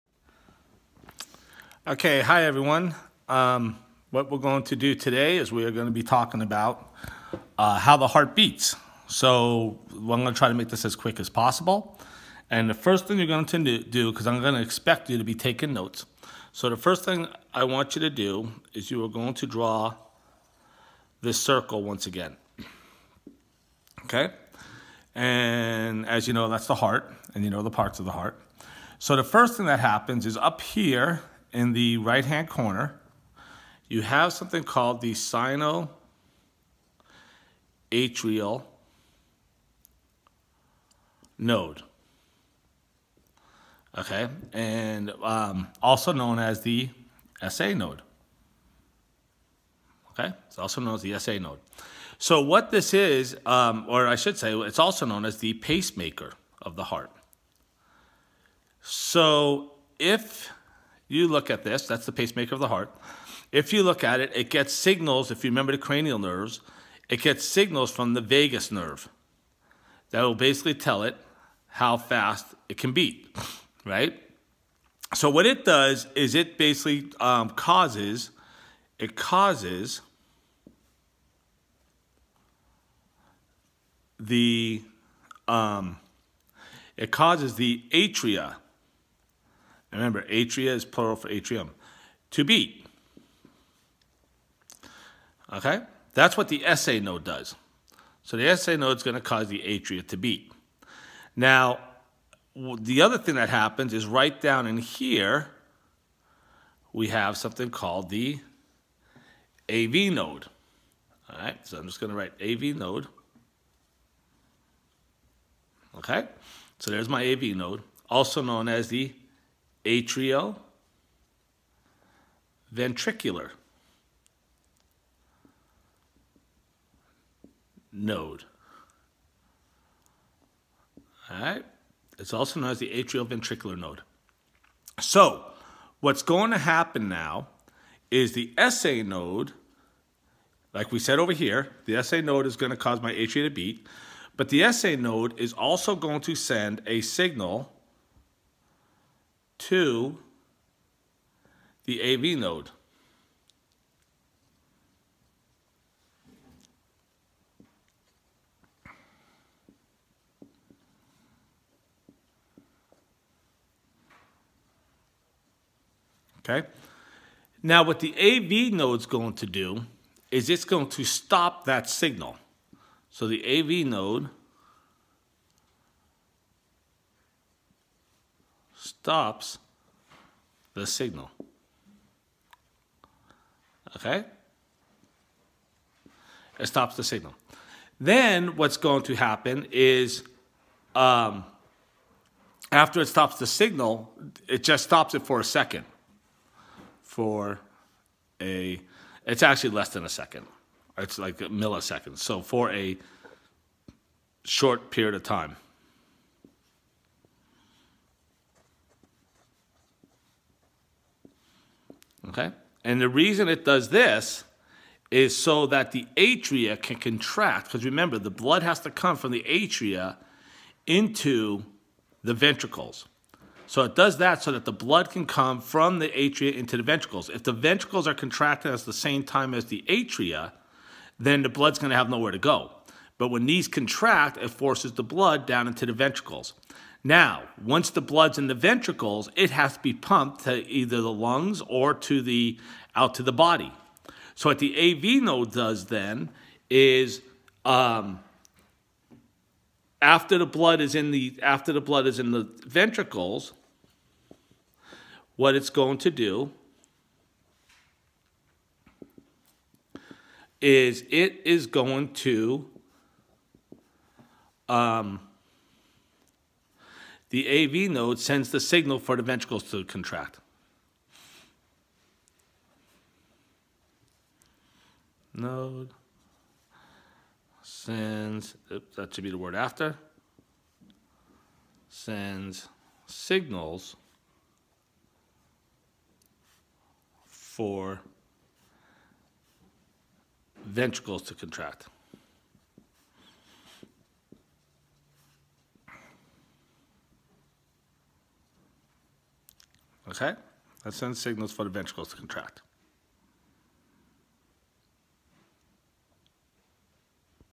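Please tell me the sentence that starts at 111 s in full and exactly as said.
All right, so I'm just going to write AV node.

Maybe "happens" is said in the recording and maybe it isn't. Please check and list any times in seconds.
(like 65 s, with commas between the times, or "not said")
29 s, 103 s, 136 s, 189 s.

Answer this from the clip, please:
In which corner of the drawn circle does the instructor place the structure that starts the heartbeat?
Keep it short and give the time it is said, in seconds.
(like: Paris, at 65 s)
right-hand corner, at 31 s.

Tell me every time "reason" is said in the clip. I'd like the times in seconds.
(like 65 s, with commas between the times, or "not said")
213 s.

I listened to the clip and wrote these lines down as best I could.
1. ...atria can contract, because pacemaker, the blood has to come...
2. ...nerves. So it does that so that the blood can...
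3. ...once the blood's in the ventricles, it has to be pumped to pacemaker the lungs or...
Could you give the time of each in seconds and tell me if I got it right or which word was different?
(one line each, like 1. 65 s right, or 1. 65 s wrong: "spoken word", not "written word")
1. 216 s wrong: "remember", not "pacemaker"
2. 222 s wrong: "ventricles", not "nerves"
3. 237 s wrong: "either", not "pacemaker".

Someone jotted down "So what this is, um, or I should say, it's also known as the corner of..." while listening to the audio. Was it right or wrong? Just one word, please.
wrong.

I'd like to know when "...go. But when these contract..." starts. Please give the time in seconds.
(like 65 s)
232 s.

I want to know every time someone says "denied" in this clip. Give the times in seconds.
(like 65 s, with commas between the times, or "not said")
not said.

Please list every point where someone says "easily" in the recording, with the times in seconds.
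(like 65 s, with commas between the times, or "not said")
not said.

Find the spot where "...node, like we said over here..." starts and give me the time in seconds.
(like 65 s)
139 s.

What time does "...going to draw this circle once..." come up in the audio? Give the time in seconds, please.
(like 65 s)
19 s.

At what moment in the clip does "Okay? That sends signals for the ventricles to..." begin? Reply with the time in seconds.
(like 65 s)
300 s.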